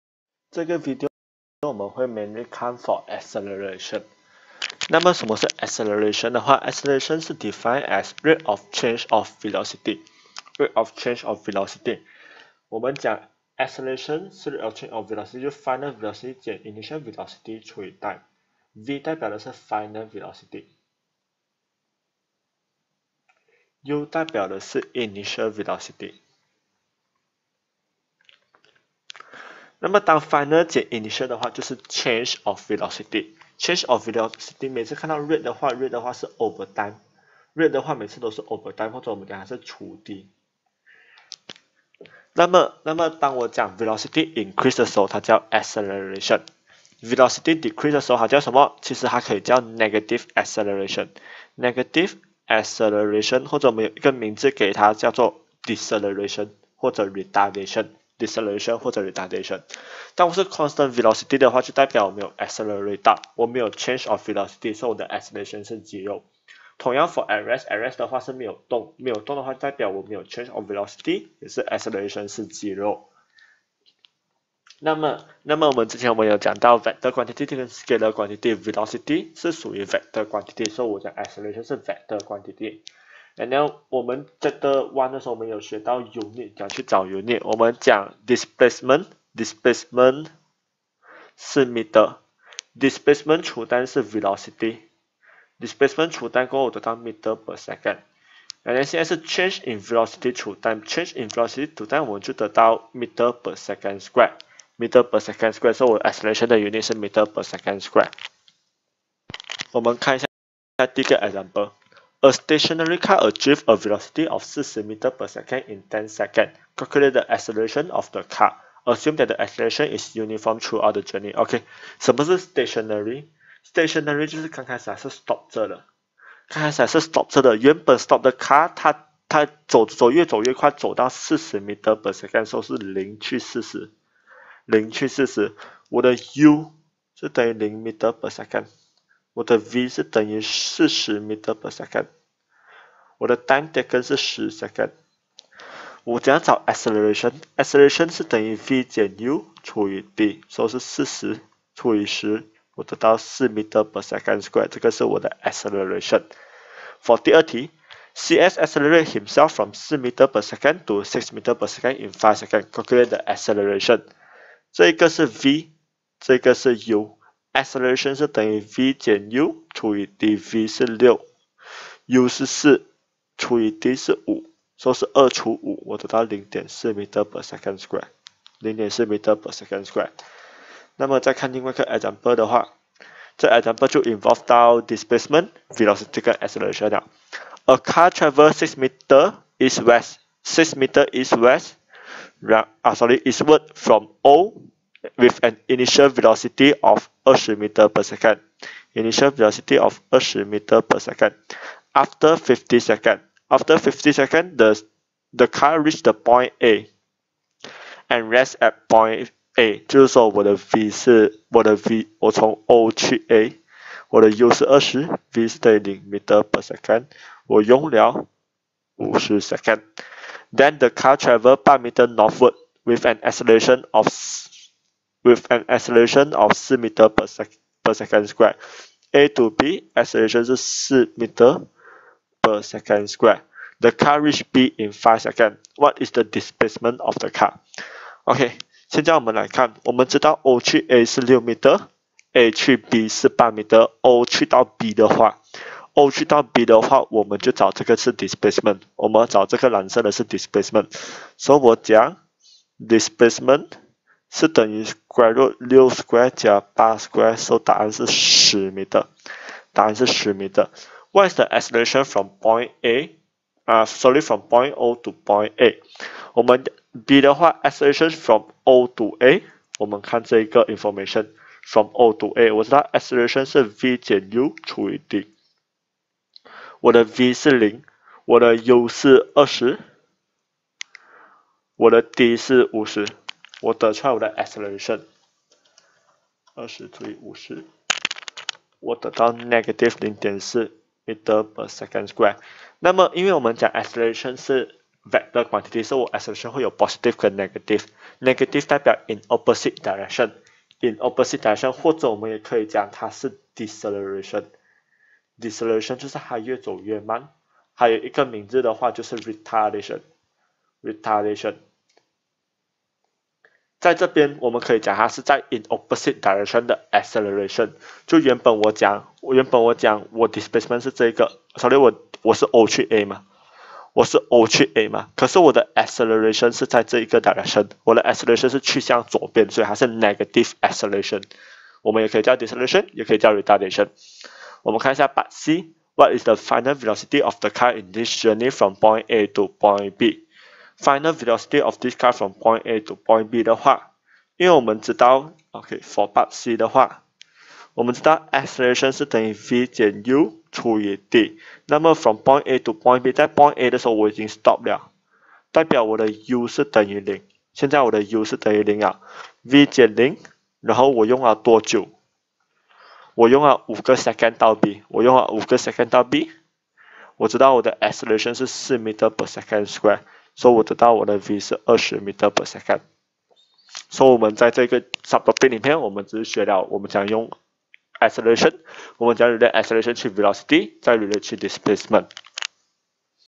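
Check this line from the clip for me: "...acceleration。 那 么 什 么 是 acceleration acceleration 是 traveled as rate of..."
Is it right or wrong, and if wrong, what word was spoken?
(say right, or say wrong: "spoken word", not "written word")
wrong: "defined", not "traveled".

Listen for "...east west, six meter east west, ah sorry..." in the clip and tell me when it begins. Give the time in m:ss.
3:09.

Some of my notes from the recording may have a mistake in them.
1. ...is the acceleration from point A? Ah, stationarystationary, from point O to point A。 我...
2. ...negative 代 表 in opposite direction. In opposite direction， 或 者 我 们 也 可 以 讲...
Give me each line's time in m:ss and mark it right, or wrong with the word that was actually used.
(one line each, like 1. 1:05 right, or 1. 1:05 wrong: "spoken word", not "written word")
1. 4:21 wrong: "sorry", not "stationarystationary"
2. 4:58 right.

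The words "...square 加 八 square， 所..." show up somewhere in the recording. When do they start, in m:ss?
4:15.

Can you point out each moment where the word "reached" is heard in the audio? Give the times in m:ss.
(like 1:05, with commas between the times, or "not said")
3:25, 3:54.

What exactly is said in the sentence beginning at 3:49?
A to B acceleration 是 4 meter。 per second square.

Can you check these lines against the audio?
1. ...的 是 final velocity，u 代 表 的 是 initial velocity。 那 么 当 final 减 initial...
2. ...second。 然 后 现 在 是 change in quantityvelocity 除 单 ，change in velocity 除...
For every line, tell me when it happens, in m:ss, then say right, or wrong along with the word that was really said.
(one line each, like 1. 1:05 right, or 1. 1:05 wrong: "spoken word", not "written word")
1. 0:19 right
2. 1:37 wrong: "velocity", not "quantityvelocity".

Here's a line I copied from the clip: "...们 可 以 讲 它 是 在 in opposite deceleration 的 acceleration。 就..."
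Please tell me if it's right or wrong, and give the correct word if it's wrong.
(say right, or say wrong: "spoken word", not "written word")
wrong: "direction", not "deceleration".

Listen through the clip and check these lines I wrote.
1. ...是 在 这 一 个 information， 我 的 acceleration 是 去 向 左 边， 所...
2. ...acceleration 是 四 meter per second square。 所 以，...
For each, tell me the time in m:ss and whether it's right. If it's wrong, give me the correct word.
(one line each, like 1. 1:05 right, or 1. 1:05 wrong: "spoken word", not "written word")
1. 5:26 wrong: "direction", not "information"
2. 6:07 right.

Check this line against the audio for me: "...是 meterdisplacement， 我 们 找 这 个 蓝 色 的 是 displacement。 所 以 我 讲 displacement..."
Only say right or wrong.
wrong.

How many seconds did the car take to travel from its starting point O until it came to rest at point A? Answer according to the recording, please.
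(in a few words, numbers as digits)
50 seconds.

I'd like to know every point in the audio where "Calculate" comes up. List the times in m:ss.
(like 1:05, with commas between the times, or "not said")
1:56, 2:42.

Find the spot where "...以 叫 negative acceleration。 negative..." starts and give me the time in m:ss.
0:49.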